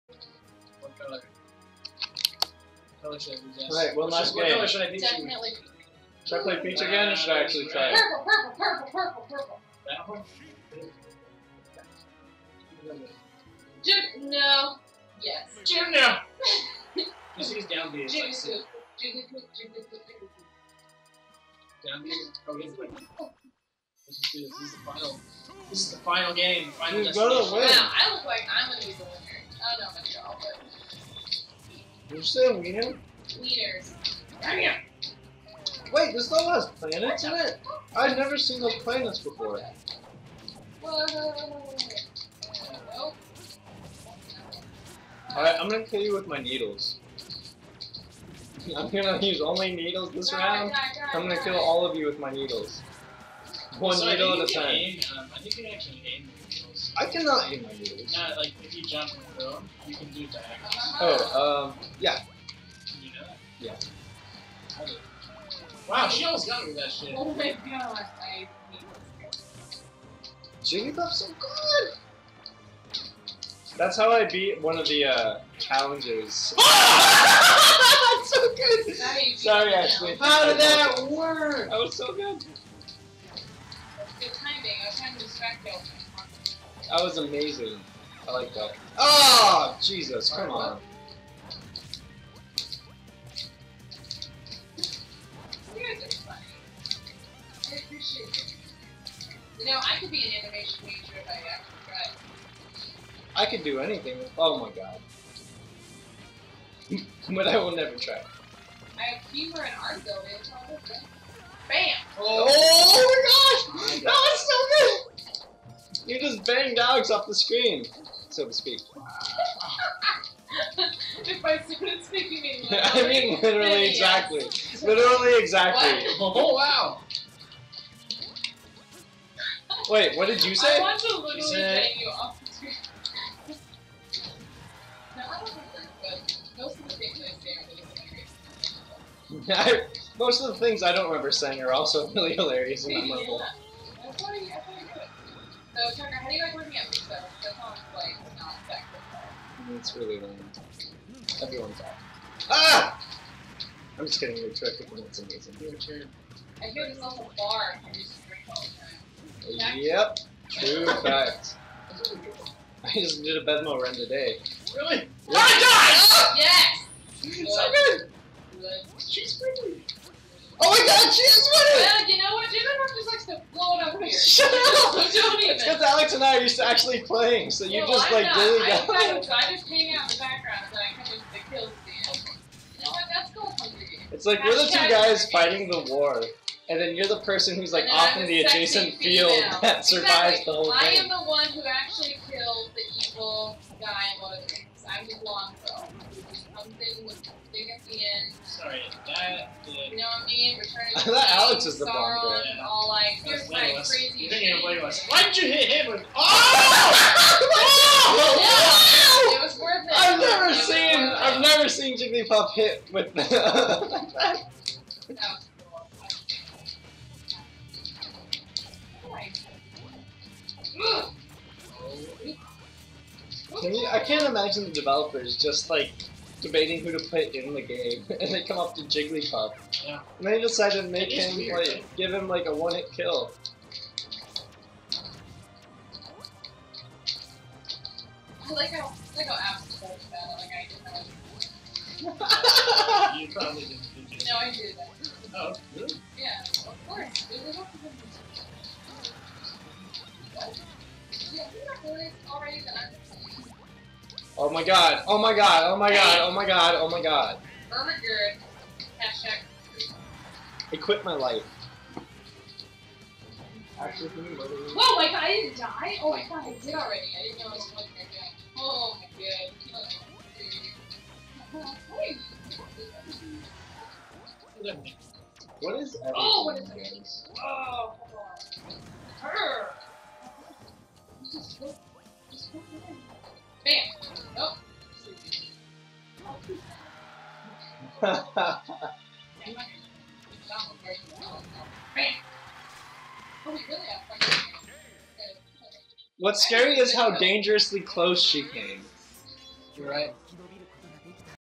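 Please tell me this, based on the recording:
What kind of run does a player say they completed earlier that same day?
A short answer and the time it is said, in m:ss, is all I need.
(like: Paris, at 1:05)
Bedmo run, at 2:43.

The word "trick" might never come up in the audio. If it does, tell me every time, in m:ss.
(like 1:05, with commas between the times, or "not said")
2:34.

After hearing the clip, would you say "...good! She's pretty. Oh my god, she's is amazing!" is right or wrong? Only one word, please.
wrong.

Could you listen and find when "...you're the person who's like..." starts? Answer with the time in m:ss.
3:06.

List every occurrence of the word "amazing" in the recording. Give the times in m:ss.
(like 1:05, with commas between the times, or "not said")
1:27, 2:35.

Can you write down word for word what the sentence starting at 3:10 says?
I am the one who actually killed the evil guy in one of the I'm the long girl.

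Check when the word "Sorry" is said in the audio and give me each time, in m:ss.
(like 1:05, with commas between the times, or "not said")
1:19, 3:18.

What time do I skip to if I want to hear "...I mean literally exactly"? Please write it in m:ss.
2:02.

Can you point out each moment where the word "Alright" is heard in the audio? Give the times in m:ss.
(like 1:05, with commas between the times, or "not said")
0:03, 0:40.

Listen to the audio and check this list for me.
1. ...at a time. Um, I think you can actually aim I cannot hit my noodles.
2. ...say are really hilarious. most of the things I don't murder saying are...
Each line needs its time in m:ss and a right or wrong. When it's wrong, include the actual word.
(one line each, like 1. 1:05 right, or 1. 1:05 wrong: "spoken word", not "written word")
1. 0:54 right
2. 2:17 wrong: "remember", not "murder".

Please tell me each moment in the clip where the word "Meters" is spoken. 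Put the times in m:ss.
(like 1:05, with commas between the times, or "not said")
0:33.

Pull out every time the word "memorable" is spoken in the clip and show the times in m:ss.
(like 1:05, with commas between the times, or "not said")
2:22.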